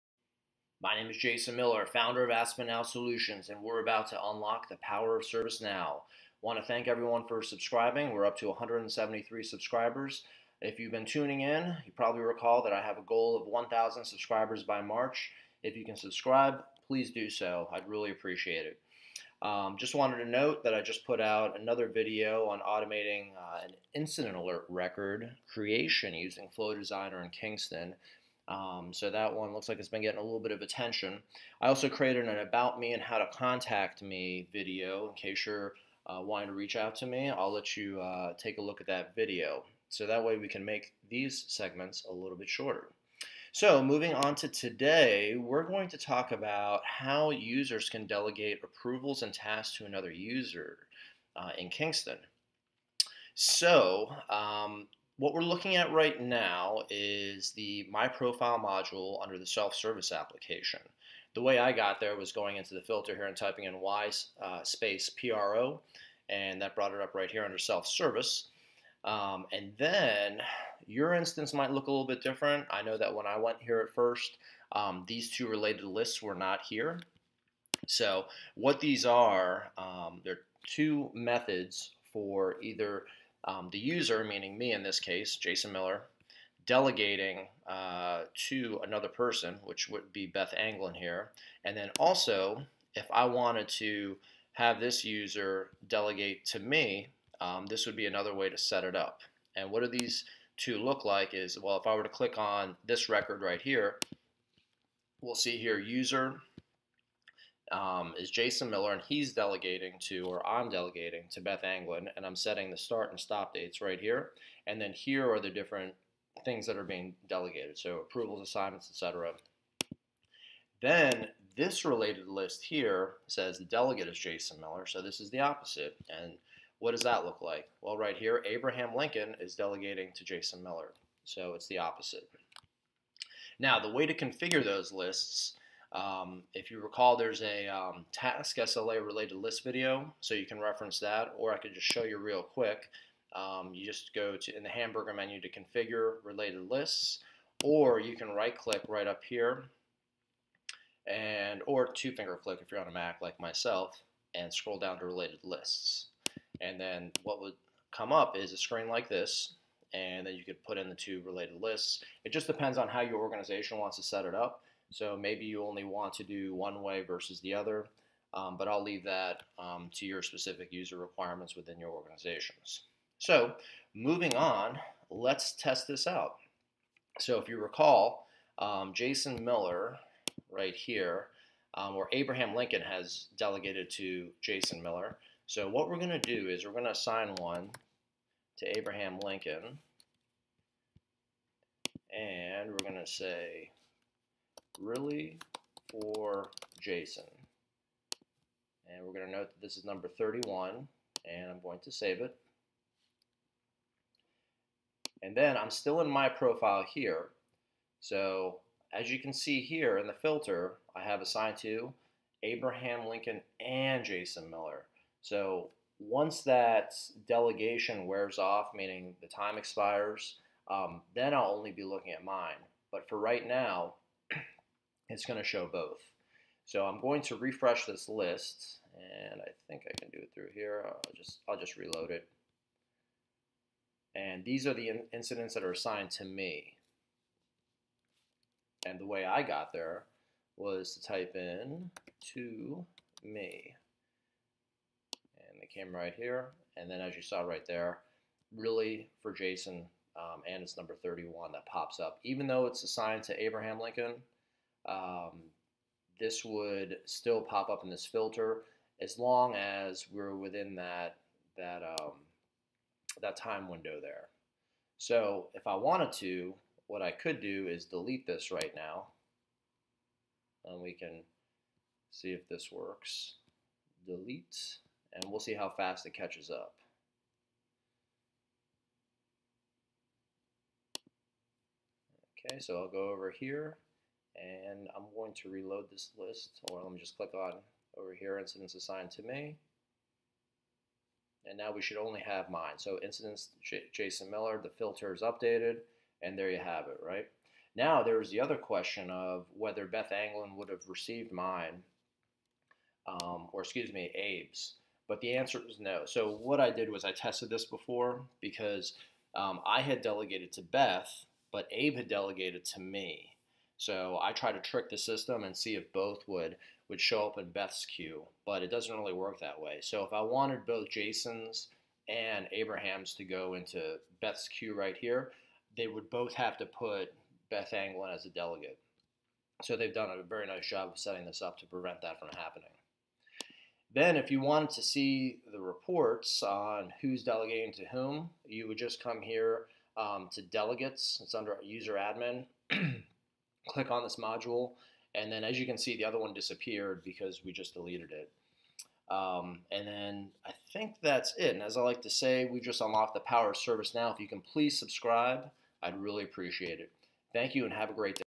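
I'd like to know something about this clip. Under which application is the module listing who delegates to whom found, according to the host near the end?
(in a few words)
User admin.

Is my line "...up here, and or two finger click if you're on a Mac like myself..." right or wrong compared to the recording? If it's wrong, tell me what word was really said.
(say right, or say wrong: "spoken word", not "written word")
right.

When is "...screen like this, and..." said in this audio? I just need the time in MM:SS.
02:38.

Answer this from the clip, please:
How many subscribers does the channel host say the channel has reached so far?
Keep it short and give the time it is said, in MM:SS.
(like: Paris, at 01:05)
173, at 00:08.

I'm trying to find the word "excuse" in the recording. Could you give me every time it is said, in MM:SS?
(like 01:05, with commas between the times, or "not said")
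05:03.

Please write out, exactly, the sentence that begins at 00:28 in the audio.
Um, so that one looks like it's been getting a little bit of attention.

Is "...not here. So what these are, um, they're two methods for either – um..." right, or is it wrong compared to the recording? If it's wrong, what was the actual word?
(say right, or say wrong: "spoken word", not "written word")
right.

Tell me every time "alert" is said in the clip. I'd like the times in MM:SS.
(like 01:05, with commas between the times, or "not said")
00:24.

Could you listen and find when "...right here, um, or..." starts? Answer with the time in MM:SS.
03:00.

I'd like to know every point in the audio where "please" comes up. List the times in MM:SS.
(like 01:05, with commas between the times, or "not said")
00:16, 05:54.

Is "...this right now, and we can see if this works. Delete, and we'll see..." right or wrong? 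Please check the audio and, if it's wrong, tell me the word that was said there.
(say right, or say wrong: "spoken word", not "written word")
right.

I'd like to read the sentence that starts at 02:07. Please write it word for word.
Well, right here, Abraham Lincoln is delegating to Jason Miller, so it's the opposite.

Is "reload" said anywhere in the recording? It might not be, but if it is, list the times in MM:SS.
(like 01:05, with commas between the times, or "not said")
03:51, 04:45.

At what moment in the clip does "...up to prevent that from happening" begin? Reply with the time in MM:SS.
05:31.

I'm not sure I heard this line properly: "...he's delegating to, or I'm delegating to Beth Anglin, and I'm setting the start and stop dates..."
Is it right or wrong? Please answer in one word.
right.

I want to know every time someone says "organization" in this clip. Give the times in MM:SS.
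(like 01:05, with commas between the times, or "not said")
02:43, 02:51.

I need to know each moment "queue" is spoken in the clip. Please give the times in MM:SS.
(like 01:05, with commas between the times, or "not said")
05:17, 05:24.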